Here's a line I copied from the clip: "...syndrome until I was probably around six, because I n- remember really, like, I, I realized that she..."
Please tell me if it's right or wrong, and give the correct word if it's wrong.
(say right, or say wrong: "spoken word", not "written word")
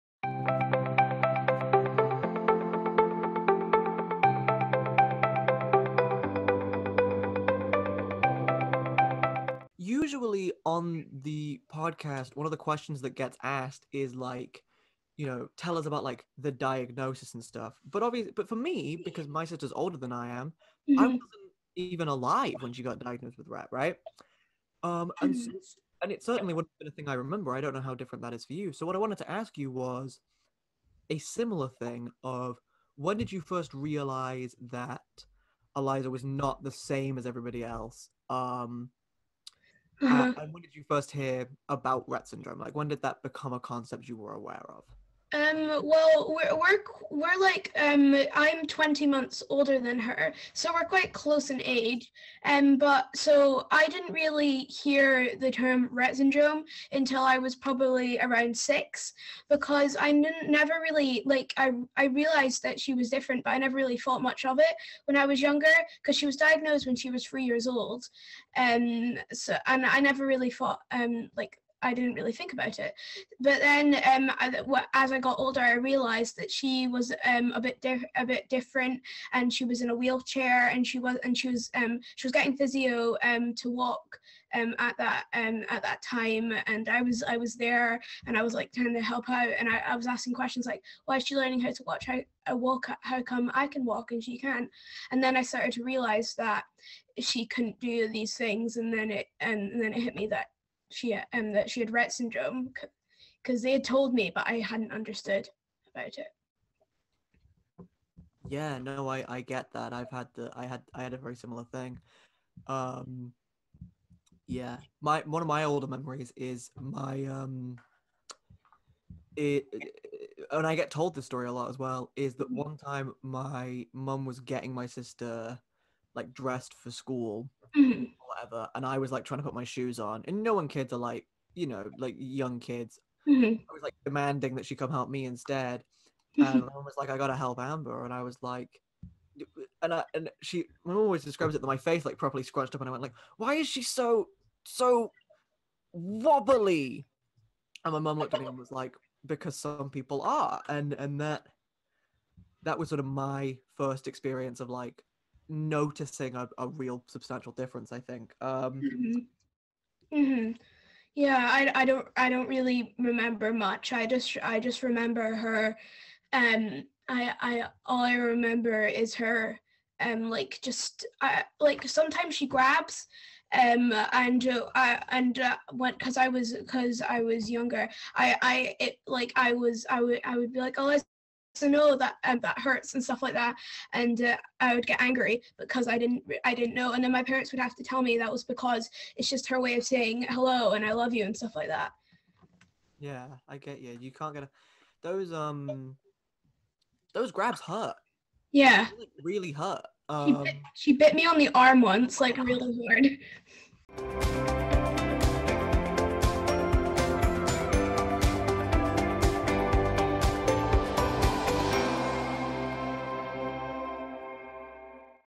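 wrong: "never", not "remember".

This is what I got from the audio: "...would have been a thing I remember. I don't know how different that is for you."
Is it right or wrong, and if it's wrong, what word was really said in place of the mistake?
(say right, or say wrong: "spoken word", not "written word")
right.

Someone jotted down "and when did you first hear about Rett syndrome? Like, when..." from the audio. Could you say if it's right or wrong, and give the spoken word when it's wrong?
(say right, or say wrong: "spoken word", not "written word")
right.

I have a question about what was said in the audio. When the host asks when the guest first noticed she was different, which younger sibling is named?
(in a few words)
Eliza.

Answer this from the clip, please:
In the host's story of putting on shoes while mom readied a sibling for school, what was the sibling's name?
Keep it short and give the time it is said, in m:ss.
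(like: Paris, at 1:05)
Amber, at 2:17.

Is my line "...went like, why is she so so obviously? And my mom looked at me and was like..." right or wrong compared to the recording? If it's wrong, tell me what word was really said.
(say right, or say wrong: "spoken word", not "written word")
wrong: "wobbly", not "obviously".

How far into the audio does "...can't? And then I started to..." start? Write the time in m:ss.
1:34.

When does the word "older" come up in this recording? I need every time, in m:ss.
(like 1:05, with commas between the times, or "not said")
0:19, 0:49, 1:15, 1:55.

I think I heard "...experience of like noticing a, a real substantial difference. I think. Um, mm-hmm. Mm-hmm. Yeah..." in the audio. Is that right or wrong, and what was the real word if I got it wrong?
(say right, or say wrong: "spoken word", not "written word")
right.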